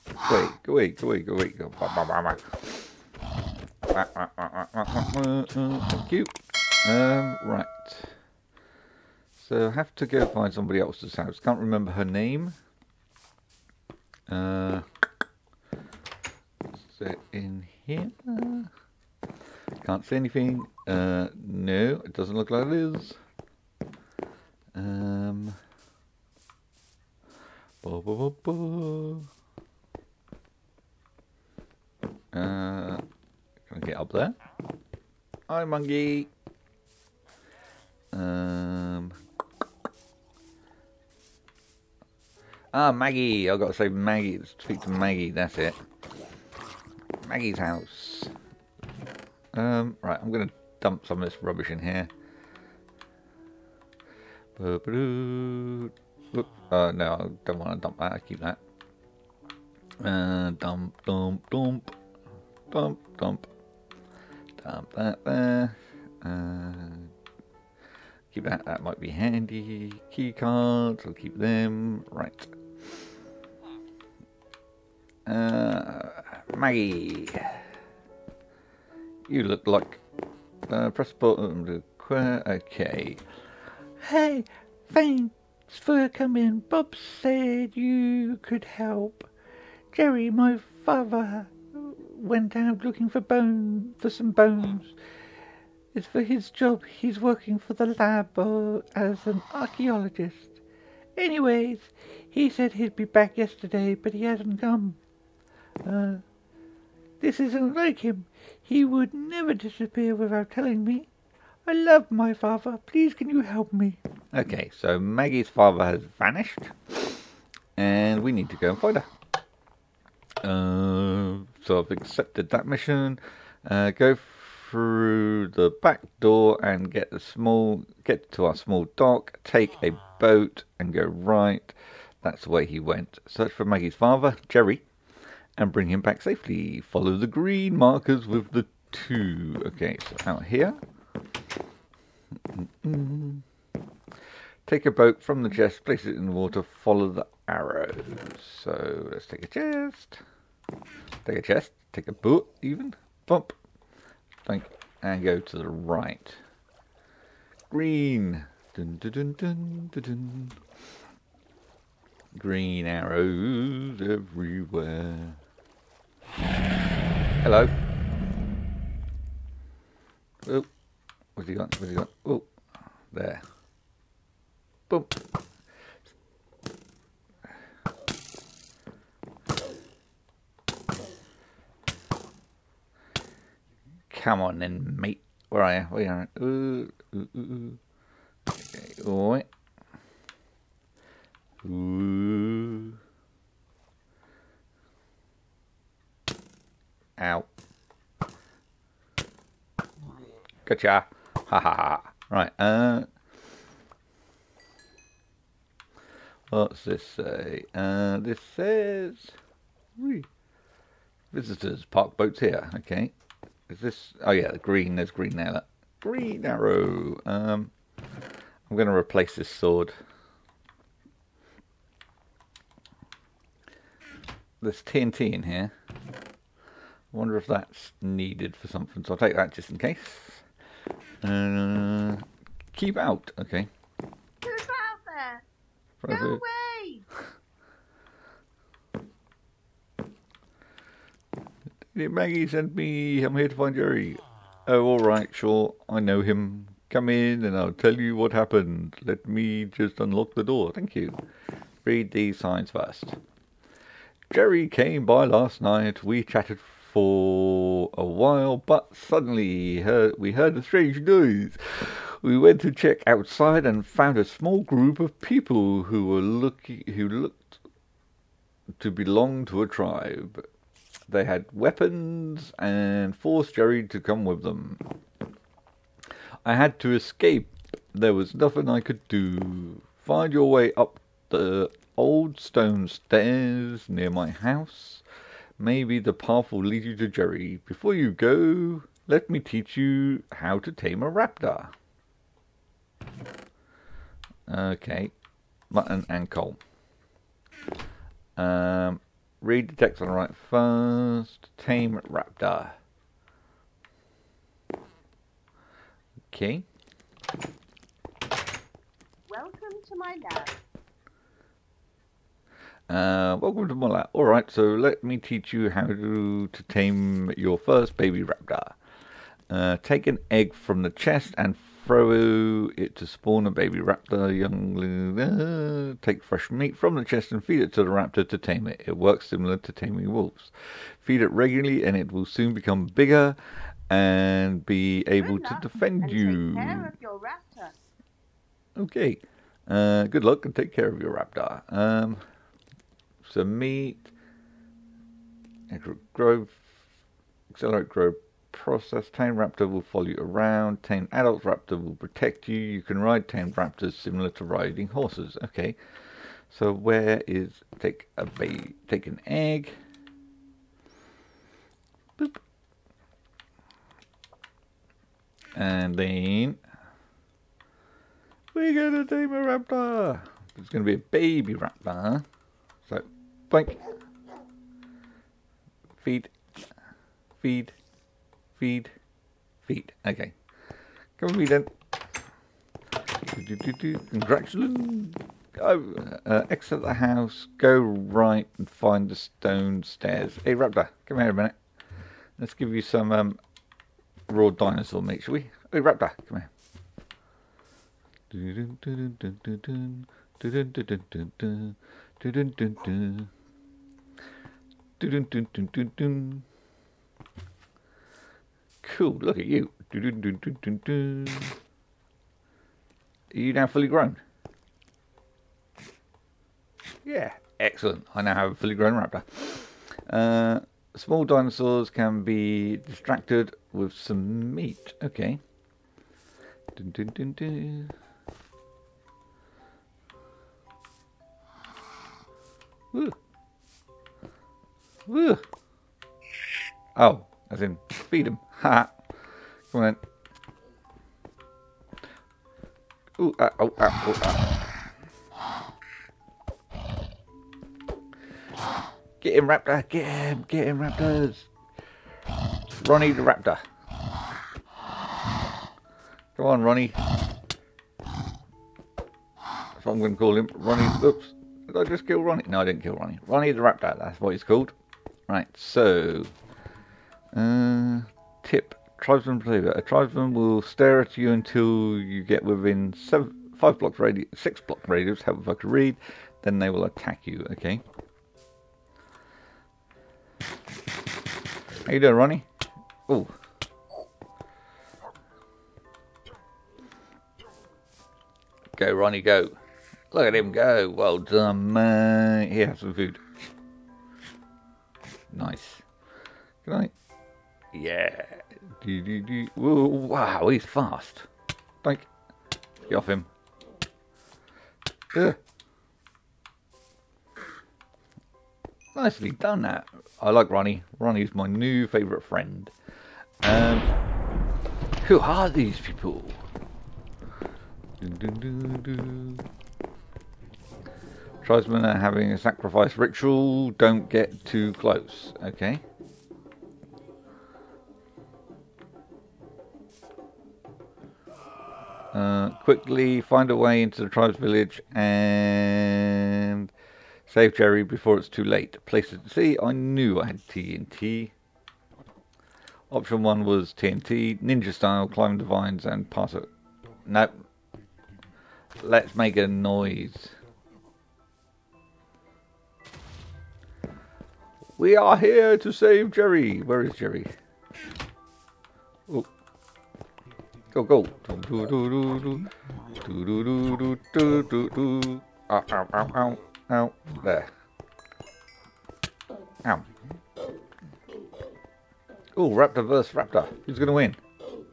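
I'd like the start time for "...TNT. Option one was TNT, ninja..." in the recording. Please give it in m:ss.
9:00.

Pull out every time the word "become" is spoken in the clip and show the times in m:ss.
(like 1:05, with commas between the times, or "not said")
5:32.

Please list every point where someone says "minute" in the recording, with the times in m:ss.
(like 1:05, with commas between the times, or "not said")
6:31.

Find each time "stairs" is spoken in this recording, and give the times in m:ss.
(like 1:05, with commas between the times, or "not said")
4:42, 6:29.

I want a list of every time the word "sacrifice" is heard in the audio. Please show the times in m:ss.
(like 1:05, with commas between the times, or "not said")
8:42.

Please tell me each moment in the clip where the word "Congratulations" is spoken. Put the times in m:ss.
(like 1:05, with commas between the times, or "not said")
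6:24.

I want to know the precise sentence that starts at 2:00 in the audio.
Uh, so I've accepted that mission.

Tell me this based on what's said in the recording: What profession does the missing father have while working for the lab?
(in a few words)
Archaeologist.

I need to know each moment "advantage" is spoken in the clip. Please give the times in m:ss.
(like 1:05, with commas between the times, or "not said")
not said.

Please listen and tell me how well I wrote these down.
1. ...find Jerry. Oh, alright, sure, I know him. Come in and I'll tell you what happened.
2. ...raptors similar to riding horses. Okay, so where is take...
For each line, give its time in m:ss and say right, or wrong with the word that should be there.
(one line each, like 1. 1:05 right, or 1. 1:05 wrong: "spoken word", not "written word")
1. 4:03 right
2. 5:53 right.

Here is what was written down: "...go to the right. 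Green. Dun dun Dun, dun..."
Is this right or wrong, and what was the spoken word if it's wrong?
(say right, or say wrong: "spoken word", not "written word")
right.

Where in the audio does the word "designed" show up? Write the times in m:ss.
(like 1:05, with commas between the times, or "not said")
not said.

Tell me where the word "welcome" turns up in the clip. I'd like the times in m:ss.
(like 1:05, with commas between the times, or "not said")
5:09, 5:13.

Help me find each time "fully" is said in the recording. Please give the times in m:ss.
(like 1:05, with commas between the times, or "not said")
6:53, 6:58.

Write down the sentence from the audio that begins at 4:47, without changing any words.
Before you go, let me teach you how to tame a raptor.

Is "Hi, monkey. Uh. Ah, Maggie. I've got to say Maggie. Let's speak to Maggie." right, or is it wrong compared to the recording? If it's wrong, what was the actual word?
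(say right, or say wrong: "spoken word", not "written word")
right.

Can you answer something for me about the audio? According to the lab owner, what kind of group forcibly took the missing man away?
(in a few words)
A tribe.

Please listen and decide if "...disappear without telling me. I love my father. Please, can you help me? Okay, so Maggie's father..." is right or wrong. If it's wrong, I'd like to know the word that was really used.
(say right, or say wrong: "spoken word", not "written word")
right.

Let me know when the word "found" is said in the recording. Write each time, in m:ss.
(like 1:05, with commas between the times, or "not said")
4:23.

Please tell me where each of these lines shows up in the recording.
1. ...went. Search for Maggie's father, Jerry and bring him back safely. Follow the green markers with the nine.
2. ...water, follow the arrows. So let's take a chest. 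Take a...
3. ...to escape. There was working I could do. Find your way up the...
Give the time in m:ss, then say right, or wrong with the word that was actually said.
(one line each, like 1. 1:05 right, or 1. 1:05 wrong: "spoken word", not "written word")
1. 2:12 wrong: "two", not "nine"
2. 2:26 right
3. 4:36 wrong: "nothing", not "working".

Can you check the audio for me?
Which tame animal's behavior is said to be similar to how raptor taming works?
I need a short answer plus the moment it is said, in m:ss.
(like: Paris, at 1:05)
Wolves, at 5:29.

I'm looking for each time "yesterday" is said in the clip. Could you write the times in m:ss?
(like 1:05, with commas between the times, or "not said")
1:43.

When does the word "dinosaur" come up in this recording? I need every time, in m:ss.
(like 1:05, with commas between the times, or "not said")
6:34, 7:01.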